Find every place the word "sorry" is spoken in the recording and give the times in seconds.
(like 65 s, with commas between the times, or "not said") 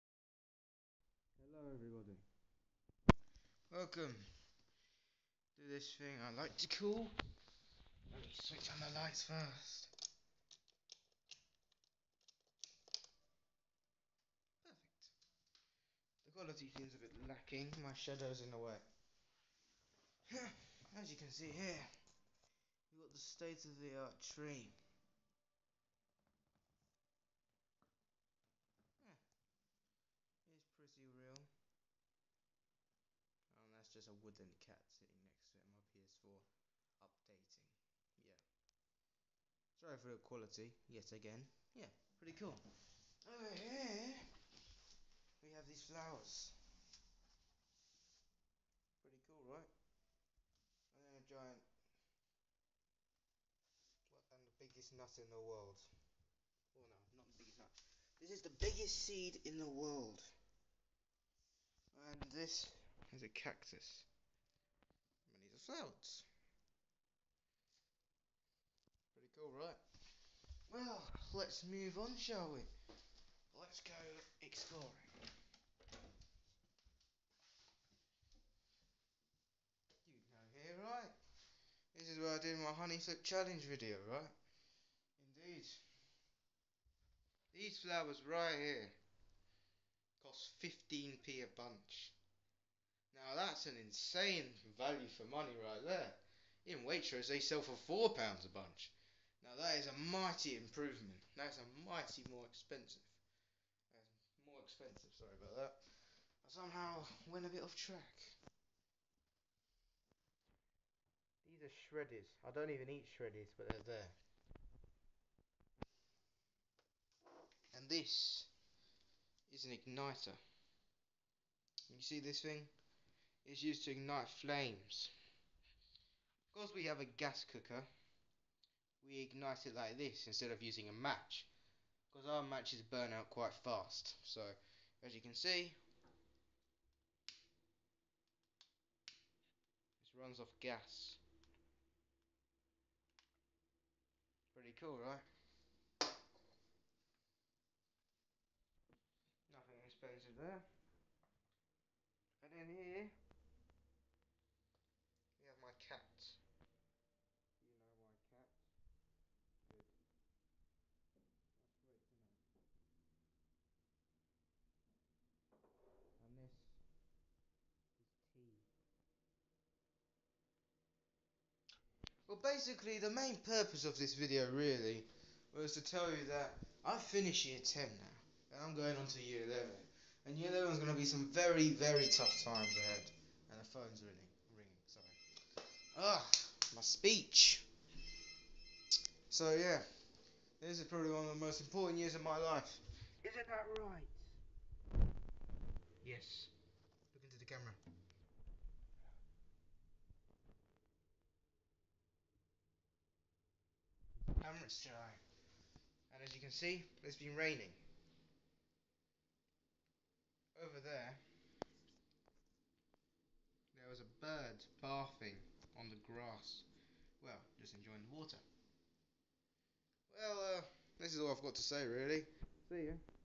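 39 s, 105 s, 184 s.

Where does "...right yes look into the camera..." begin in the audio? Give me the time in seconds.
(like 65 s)
193 s.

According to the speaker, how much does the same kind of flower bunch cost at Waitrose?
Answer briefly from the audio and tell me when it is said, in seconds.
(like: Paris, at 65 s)
4 pounds, at 97 s.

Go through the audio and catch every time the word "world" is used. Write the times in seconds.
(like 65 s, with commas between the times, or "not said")
55 s, 59 s.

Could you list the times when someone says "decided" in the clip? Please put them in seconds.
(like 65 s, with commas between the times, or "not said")
not said.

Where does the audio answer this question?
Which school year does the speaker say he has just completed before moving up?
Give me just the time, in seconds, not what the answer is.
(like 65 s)
177 s.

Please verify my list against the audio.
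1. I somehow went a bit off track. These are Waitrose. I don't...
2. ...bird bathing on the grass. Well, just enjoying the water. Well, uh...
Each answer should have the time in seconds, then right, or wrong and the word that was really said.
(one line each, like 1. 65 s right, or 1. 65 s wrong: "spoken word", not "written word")
1. 105 s wrong: "Shreddies", not "Waitrose"
2. 214 s right.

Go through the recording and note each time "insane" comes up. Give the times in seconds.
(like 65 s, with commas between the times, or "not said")
93 s.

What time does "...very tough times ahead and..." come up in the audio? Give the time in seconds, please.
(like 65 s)
181 s.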